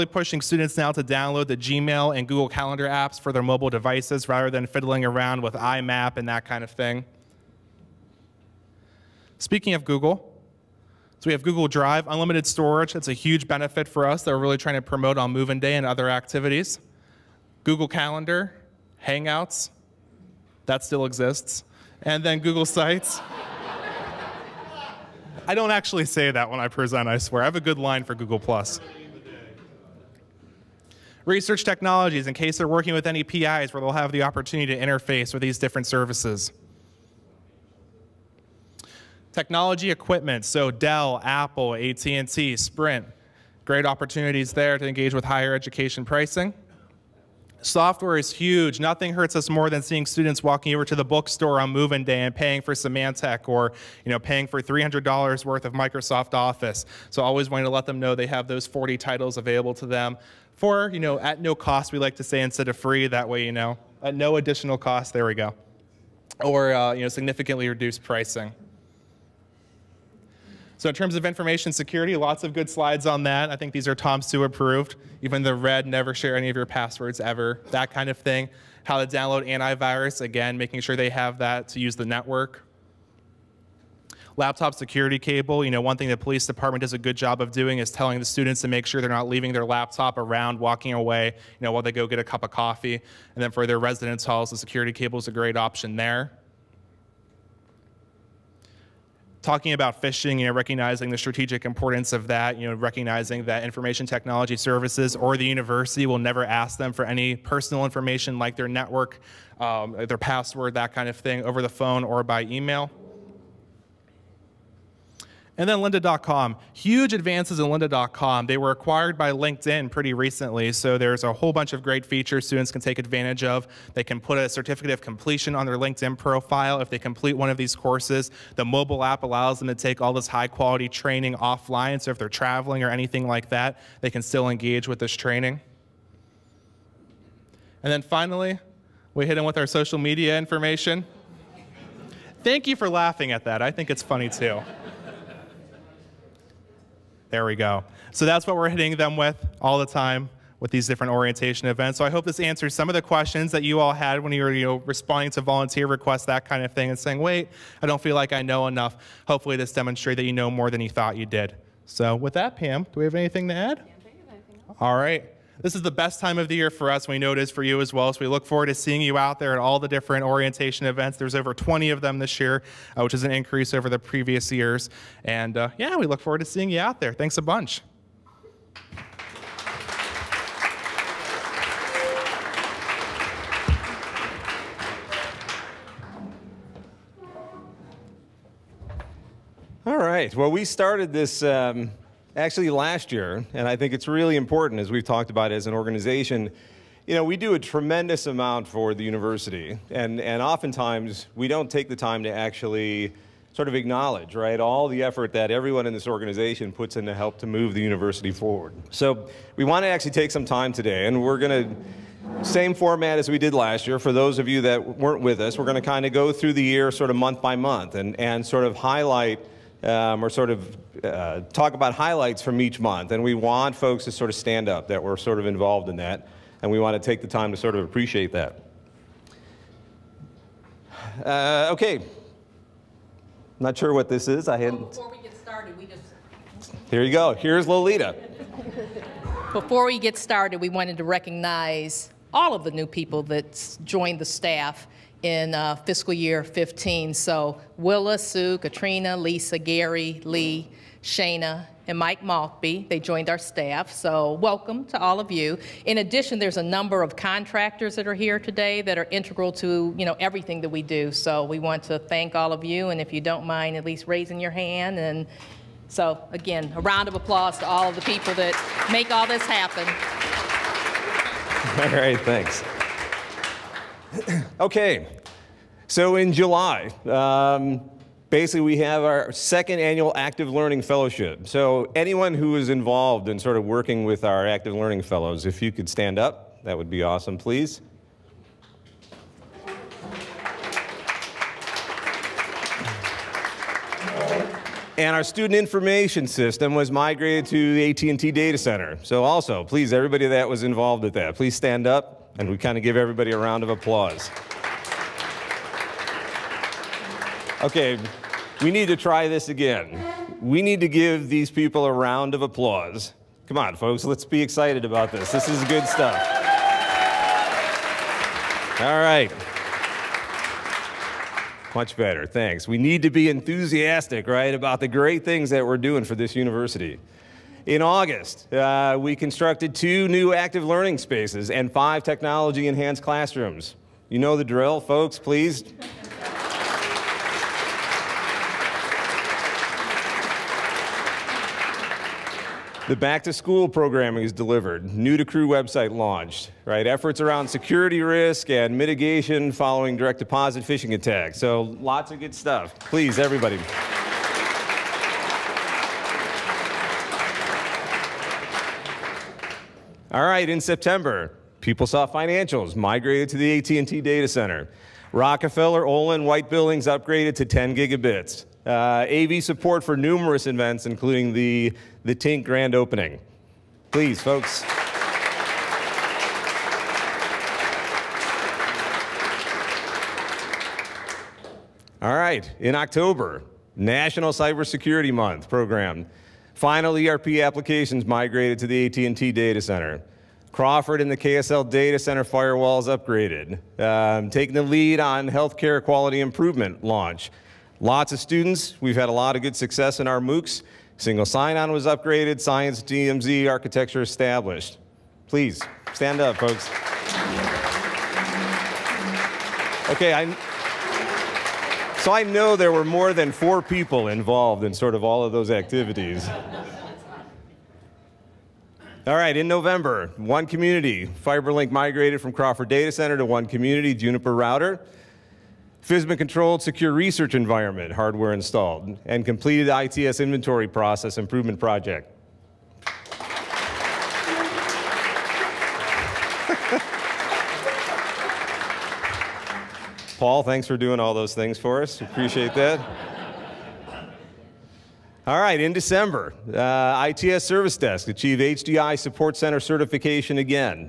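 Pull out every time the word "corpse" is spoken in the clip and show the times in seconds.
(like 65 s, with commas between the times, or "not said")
not said.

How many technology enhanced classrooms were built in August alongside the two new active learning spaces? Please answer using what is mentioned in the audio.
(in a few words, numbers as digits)
5.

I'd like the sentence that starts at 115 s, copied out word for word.
And then lynda.com, huge advances in lynda.com.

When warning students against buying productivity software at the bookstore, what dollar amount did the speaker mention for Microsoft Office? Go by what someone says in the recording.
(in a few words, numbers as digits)
$300.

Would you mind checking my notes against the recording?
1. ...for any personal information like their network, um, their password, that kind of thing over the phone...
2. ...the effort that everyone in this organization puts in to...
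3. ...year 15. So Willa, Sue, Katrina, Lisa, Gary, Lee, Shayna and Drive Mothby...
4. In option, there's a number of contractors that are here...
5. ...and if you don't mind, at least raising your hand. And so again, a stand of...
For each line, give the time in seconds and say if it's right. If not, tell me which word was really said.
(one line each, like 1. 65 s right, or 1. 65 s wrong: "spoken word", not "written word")
1. 106 s right
2. 204 s right
3. 246 s wrong: "Mike", not "Drive"
4. 255 s wrong: "addition", not "option"
5. 262 s wrong: "round", not "stand".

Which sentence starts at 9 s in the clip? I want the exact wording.
Speaking of Google, so we have Google Drive, unlimited storage.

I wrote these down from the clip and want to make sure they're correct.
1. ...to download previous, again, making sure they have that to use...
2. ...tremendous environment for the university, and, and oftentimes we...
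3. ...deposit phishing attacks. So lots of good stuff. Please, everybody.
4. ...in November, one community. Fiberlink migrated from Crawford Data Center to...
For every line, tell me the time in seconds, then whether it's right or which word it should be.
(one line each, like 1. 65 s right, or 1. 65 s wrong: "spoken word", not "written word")
1. 79 s wrong: "antivirus", not "previous"
2. 197 s wrong: "amount", not "environment"
3. 350 s right
4. 419 s right.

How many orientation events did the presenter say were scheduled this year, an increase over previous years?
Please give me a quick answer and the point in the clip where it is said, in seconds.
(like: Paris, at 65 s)
over 20, at 171 s.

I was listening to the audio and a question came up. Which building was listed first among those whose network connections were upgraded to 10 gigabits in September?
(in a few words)
Rockefeller.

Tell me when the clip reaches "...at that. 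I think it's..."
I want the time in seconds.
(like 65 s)
143 s.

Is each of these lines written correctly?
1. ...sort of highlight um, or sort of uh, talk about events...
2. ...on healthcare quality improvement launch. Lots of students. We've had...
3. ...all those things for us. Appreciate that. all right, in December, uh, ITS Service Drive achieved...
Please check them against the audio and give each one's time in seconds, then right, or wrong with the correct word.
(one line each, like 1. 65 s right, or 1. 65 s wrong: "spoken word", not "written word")
1. 218 s wrong: "highlights", not "events"
2. 395 s right
3. 441 s wrong: "Desk", not "Drive".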